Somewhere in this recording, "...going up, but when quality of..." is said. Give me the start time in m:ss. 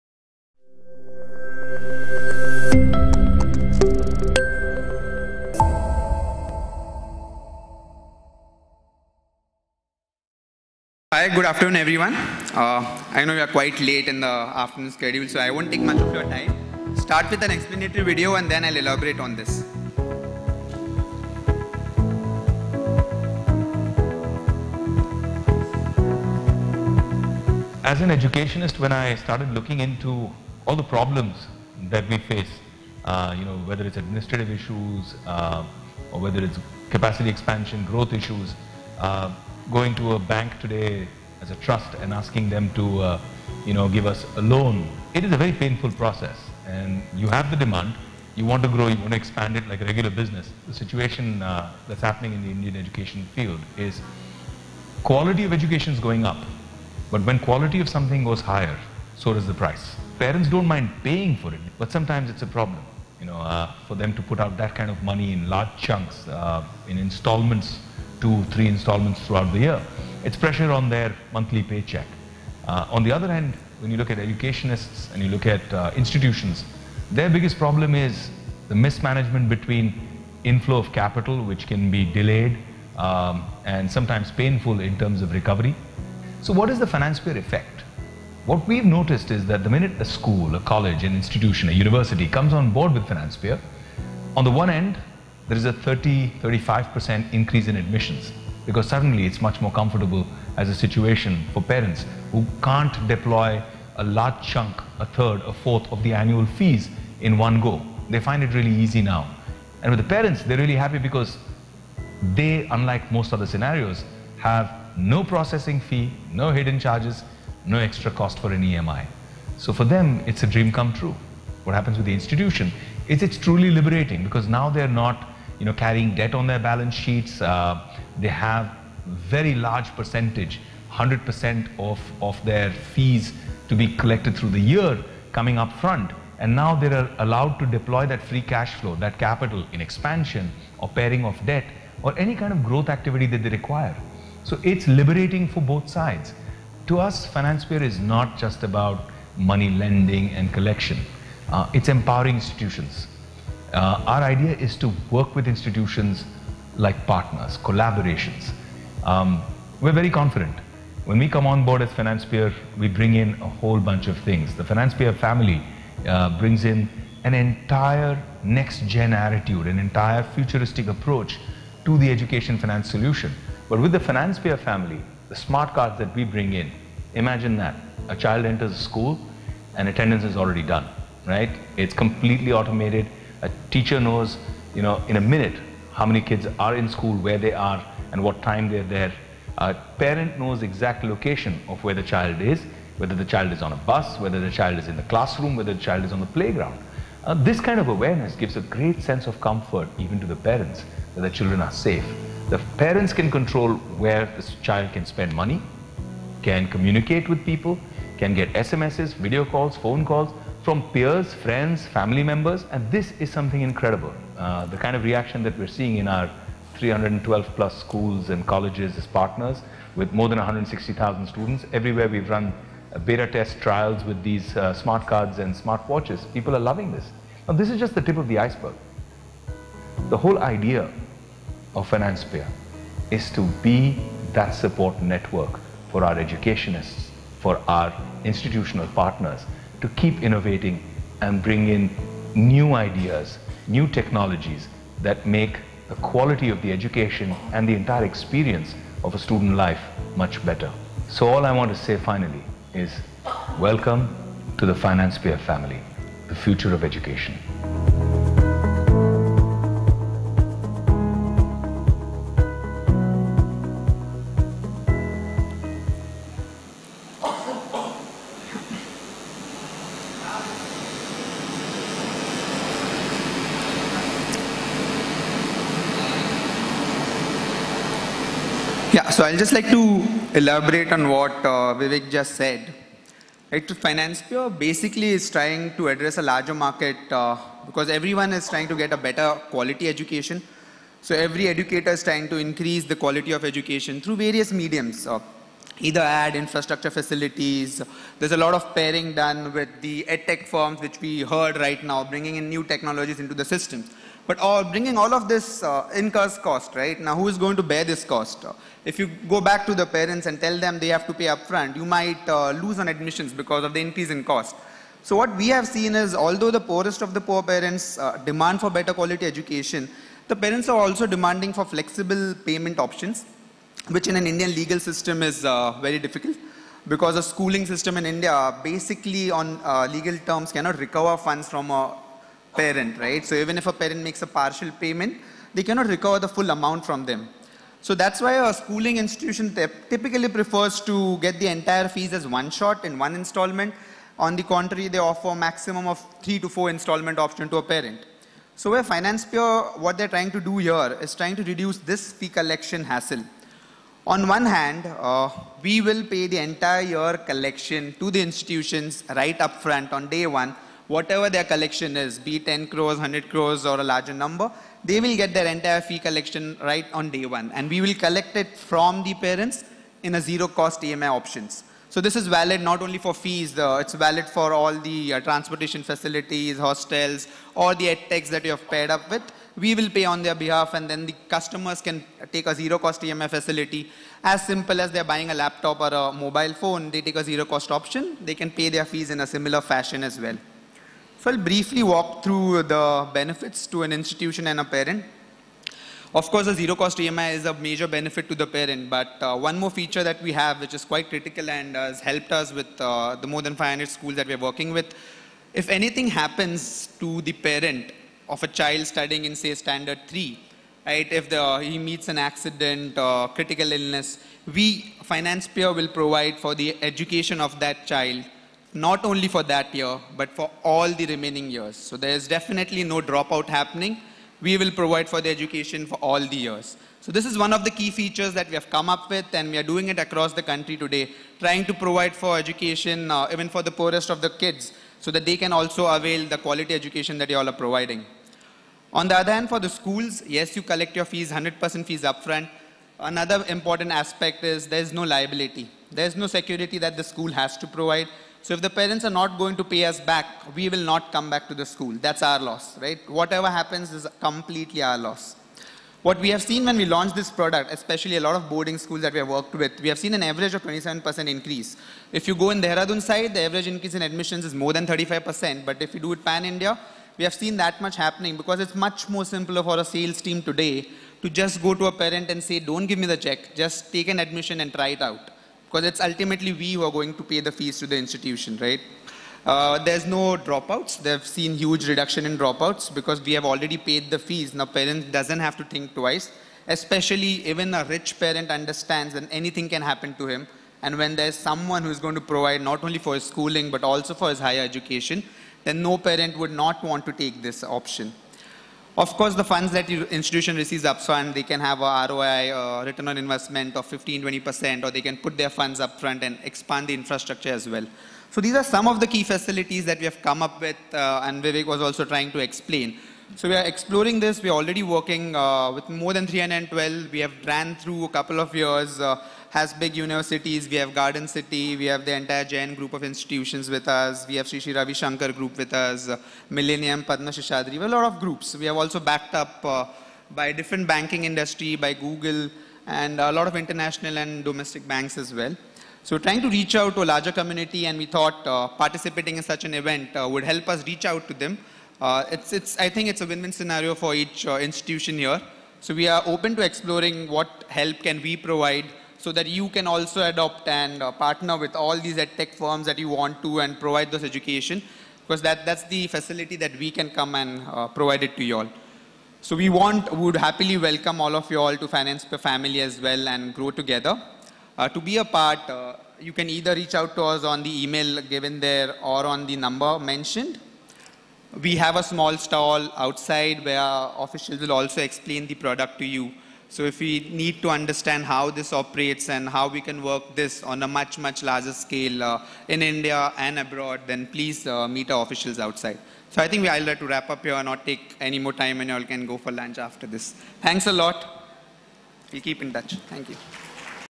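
0:55.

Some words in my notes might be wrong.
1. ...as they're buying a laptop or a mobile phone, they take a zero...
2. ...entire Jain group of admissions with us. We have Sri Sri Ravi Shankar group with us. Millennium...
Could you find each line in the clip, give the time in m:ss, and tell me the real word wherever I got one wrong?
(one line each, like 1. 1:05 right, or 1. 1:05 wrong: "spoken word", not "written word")
1. 6:24 right
2. 8:42 wrong: "institutions", not "admissions".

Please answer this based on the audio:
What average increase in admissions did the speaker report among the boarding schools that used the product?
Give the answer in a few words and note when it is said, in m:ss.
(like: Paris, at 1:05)
27%, at 7:40.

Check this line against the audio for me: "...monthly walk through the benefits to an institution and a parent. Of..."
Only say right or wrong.
wrong.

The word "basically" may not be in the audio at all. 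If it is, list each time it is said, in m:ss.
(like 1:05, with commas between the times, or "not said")
4:44, 5:28.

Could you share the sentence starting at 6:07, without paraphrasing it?
And we will collect it from the parents in a zero cost EMI options.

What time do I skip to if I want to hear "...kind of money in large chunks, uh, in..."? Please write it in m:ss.
1:04.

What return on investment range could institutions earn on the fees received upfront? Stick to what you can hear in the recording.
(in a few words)
15-20%.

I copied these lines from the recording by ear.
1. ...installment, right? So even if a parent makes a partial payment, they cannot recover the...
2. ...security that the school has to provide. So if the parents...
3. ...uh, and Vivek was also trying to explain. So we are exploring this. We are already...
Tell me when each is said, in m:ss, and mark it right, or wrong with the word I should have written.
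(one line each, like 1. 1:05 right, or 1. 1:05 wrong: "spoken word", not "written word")
1. 5:32 wrong: "parent", not "installment"
2. 7:26 right
3. 8:30 right.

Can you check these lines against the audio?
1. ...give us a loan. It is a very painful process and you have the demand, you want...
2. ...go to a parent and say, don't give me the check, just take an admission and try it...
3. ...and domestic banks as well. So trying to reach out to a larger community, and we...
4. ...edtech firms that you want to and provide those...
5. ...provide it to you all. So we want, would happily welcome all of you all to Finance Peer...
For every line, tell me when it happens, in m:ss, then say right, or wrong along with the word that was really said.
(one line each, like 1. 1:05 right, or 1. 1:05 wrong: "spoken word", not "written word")
1. 0:43 right
2. 7:51 right
3. 8:54 right
4. 9:12 right
5. 9:17 right.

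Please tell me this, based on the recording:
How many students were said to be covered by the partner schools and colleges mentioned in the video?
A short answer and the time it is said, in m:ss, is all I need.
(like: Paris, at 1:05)
160,000, at 3:40.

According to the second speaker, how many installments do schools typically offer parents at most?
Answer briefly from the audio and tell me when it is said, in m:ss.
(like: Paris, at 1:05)
3 to 4, at 5:46.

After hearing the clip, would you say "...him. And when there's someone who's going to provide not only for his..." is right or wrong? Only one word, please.
right.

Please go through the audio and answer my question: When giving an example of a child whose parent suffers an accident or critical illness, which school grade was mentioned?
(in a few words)
Standard 3.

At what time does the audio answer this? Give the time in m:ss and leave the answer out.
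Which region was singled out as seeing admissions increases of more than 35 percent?
7:42.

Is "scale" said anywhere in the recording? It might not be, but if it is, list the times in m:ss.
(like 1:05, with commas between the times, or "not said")
9:41.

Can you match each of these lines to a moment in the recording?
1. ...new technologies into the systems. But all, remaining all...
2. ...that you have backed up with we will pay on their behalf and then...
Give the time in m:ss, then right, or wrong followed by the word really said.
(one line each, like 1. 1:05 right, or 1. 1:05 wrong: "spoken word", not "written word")
1. 5:02 wrong: "bringing", not "remaining"
2. 6:18 wrong: "paired", not "backed".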